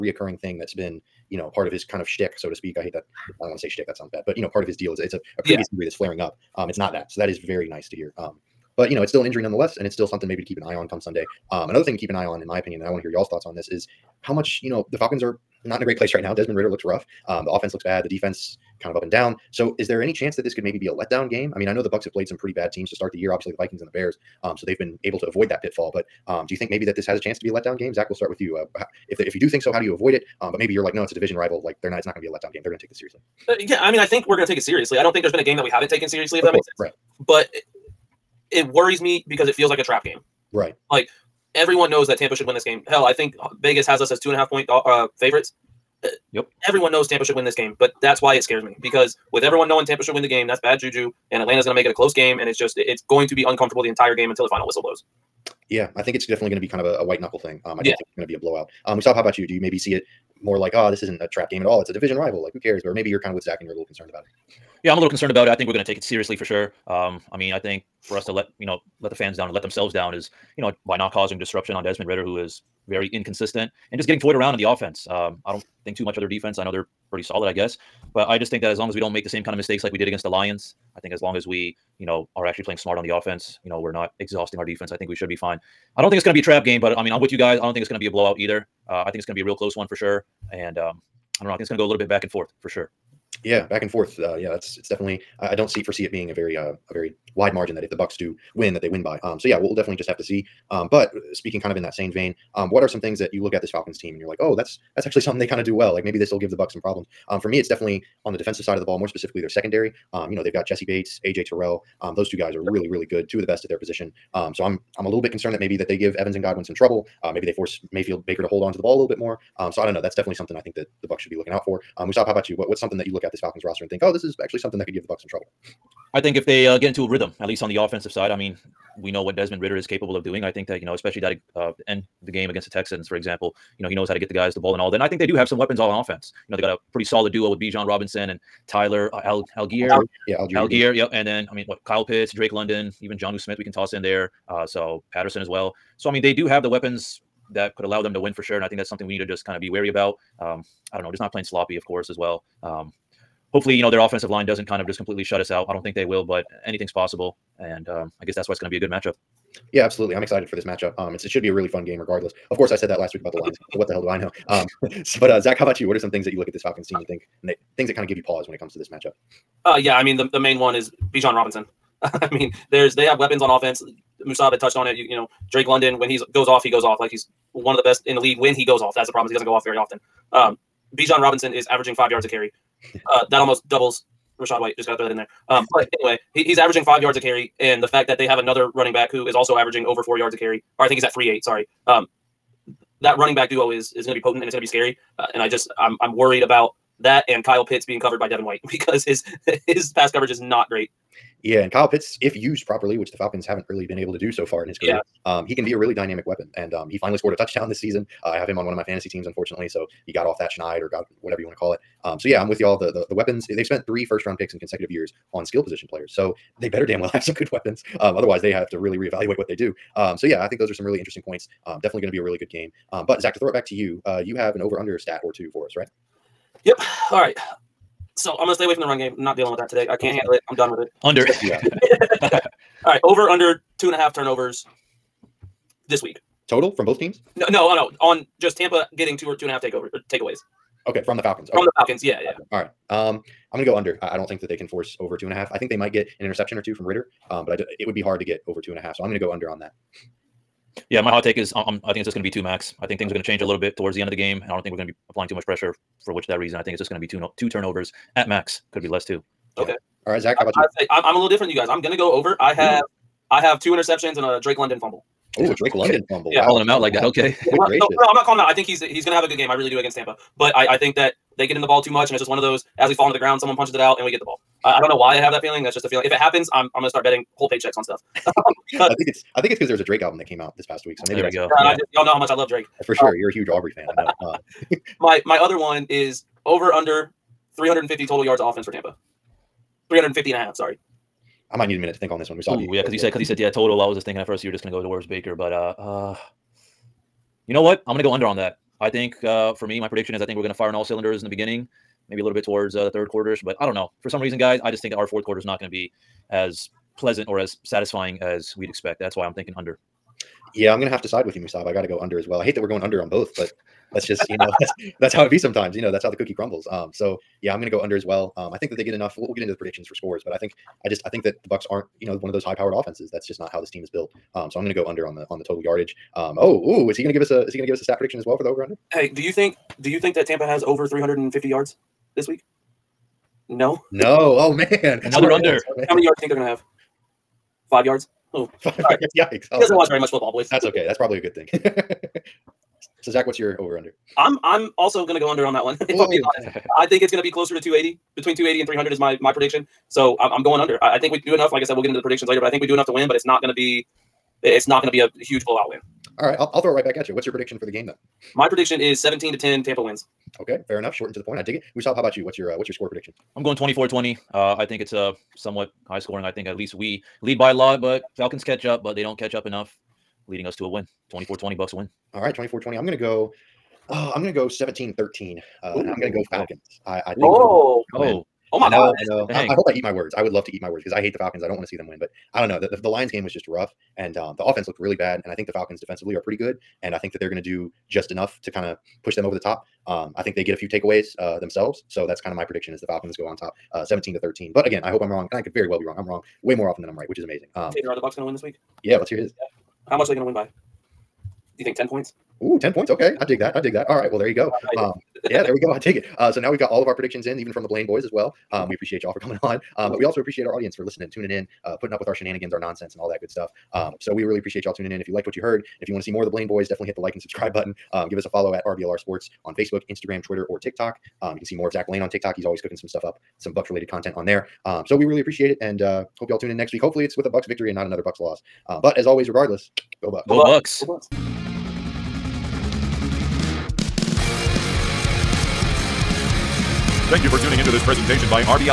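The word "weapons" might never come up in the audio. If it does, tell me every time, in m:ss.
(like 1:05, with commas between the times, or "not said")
2:15, 2:26, 2:53, 3:26, 3:33, 3:37.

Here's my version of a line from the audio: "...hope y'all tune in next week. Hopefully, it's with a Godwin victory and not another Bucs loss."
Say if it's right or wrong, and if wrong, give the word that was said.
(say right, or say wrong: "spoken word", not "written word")
wrong: "Bucs", not "Godwin".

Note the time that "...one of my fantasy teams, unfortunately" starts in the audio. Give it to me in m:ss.
3:28.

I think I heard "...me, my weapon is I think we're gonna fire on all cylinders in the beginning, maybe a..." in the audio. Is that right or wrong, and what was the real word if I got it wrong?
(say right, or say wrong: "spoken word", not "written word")
wrong: "prediction", not "weapon".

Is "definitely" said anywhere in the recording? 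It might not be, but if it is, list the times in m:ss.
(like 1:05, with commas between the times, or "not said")
0:56, 1:34, 1:39, 1:47, 2:00, 3:41, 6:56.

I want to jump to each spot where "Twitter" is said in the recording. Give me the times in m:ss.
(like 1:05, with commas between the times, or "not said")
7:00.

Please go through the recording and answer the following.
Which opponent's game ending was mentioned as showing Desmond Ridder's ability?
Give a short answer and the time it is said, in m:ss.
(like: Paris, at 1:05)
Texans, at 2:12.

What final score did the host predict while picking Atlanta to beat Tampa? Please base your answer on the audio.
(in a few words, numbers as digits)
17-13.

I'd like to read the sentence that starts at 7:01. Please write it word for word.
Um, you can see more of Zach Blaine on TikTok.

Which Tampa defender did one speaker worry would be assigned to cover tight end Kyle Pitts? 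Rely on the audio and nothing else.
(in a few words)
Devin White.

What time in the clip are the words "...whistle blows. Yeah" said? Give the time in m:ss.
0:54.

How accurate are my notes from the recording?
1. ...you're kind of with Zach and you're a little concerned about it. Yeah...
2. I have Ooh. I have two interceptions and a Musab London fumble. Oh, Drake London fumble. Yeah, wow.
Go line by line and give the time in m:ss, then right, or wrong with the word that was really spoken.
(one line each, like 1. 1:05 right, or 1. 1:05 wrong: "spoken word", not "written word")
1. 1:03 right
2. 4:22 wrong: "Drake", not "Musab".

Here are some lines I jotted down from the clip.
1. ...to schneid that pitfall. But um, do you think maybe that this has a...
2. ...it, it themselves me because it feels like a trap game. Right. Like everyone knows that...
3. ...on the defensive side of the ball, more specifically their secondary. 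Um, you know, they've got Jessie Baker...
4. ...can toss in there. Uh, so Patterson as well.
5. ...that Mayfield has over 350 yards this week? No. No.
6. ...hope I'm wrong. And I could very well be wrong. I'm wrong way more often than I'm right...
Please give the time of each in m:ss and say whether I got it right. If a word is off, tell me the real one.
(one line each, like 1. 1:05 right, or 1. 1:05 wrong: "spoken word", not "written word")
1. 0:25 wrong: "avoid", not "schneid"
2. 0:37 wrong: "worries", not "themselves"
3. 1:48 wrong: "Bates", not "Baker"
4. 2:23 right
5. 5:30 wrong: "Tampa", not "Mayfield"
6. 6:34 right.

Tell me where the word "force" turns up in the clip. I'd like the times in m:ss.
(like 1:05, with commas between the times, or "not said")
1:57, 4:04.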